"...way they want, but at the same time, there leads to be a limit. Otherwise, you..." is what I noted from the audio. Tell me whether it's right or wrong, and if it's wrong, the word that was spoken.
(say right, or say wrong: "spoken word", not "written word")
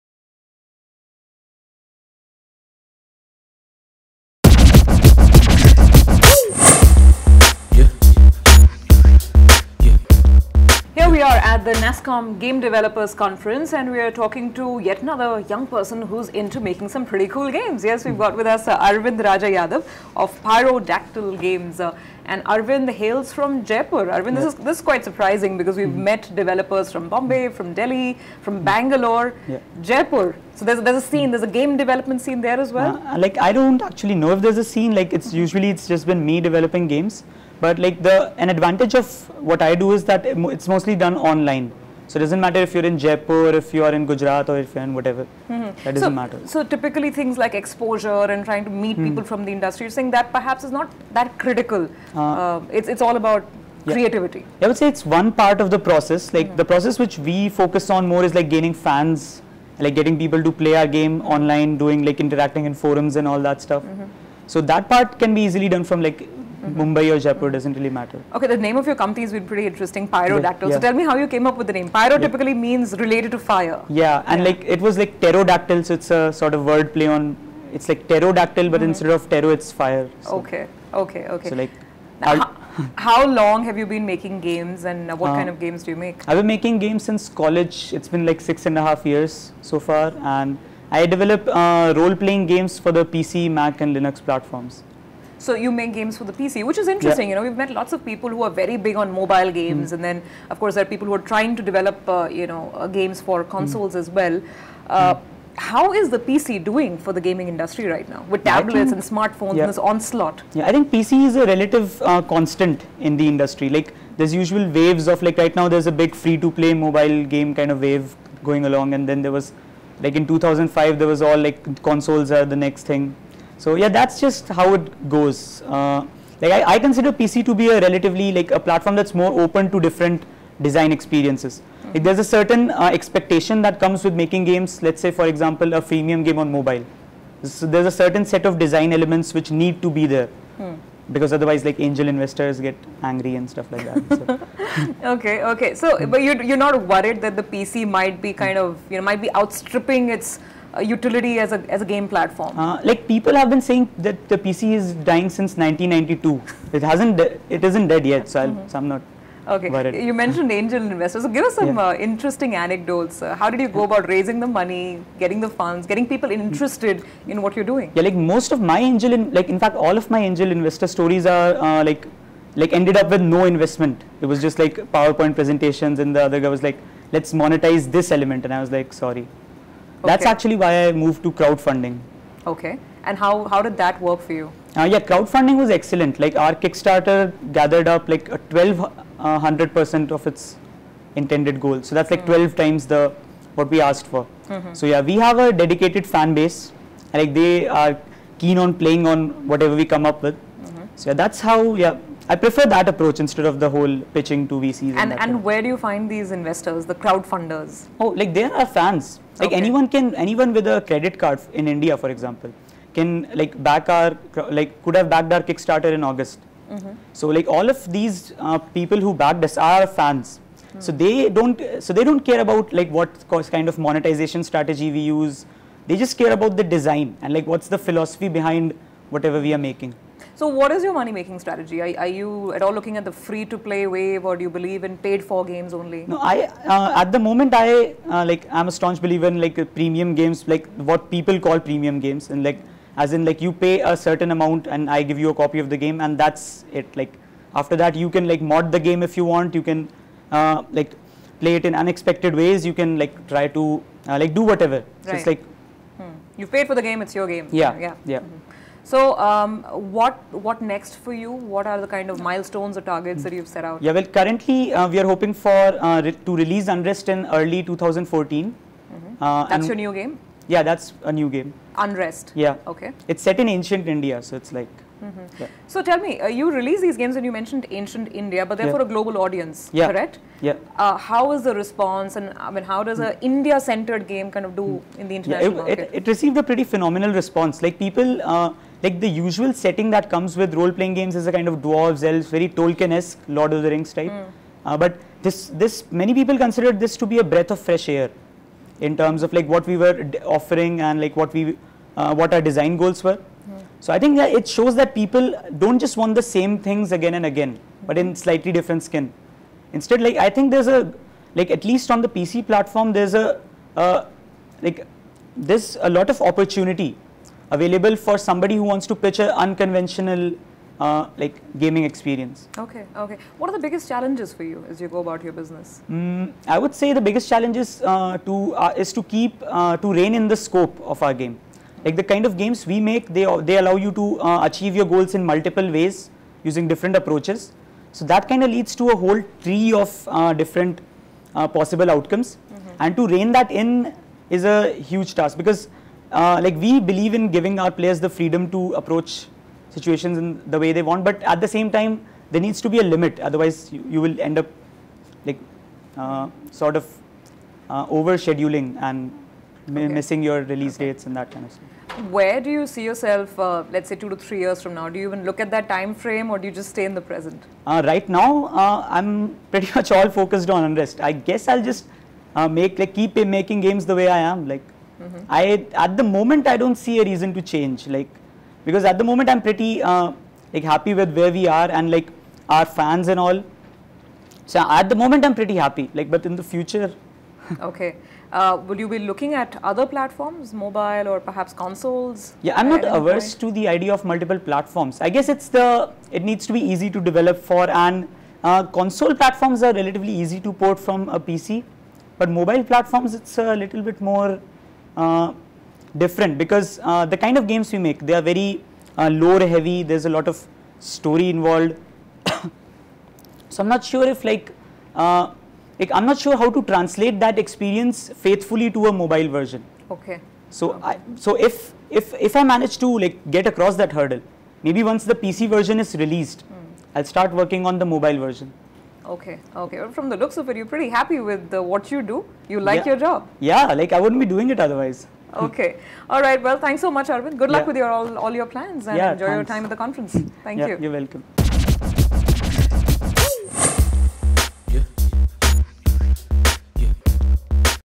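wrong: "needs", not "leads".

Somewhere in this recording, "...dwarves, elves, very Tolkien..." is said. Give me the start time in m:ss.
4:51.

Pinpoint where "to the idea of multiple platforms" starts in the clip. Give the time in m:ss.
6:33.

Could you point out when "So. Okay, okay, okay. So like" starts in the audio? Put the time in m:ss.
1:20.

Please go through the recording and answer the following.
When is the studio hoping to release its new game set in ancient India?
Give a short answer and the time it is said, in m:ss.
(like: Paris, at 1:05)
early 2014, at 4:27.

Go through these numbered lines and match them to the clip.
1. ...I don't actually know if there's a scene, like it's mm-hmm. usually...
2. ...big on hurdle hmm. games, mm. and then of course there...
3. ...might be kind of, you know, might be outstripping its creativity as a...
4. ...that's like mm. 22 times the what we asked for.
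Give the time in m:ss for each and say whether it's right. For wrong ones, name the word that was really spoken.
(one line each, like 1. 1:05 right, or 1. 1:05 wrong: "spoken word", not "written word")
1. 0:33 right
2. 1:38 wrong: "mobile", not "hurdle"
3. 2:27 wrong: "utility", not "creativity"
4. 3:11 wrong: "12", not "22".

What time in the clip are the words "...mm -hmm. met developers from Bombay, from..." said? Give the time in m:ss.
0:25.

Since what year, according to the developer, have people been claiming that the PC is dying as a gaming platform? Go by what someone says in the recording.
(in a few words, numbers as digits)
1992.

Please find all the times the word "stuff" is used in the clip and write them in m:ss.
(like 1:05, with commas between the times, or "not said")
1:03, 2:23, 6:01.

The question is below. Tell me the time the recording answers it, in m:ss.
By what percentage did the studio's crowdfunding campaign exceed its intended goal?
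3:08.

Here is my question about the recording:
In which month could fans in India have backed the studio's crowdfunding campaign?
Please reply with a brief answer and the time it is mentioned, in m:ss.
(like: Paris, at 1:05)
August, at 3:36.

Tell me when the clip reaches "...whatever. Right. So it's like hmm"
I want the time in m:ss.
4:14.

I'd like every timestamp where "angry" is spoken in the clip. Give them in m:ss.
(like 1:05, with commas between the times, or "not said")
2:23.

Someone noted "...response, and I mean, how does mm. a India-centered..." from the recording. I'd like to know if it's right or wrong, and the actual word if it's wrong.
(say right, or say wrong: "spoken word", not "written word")
right.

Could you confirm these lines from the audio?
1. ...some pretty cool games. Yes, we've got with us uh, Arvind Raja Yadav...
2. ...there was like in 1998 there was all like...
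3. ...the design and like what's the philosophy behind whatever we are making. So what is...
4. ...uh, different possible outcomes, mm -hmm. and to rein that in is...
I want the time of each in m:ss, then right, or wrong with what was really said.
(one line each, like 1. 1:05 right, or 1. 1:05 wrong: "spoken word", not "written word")
1. 0:16 right
2. 1:59 wrong: "2005", not "1998"
3. 3:46 right
4. 5:40 right.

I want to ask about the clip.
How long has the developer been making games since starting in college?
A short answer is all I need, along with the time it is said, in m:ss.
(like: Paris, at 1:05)
six and a half years, at 1:28.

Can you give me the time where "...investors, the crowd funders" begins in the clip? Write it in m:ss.
3:26.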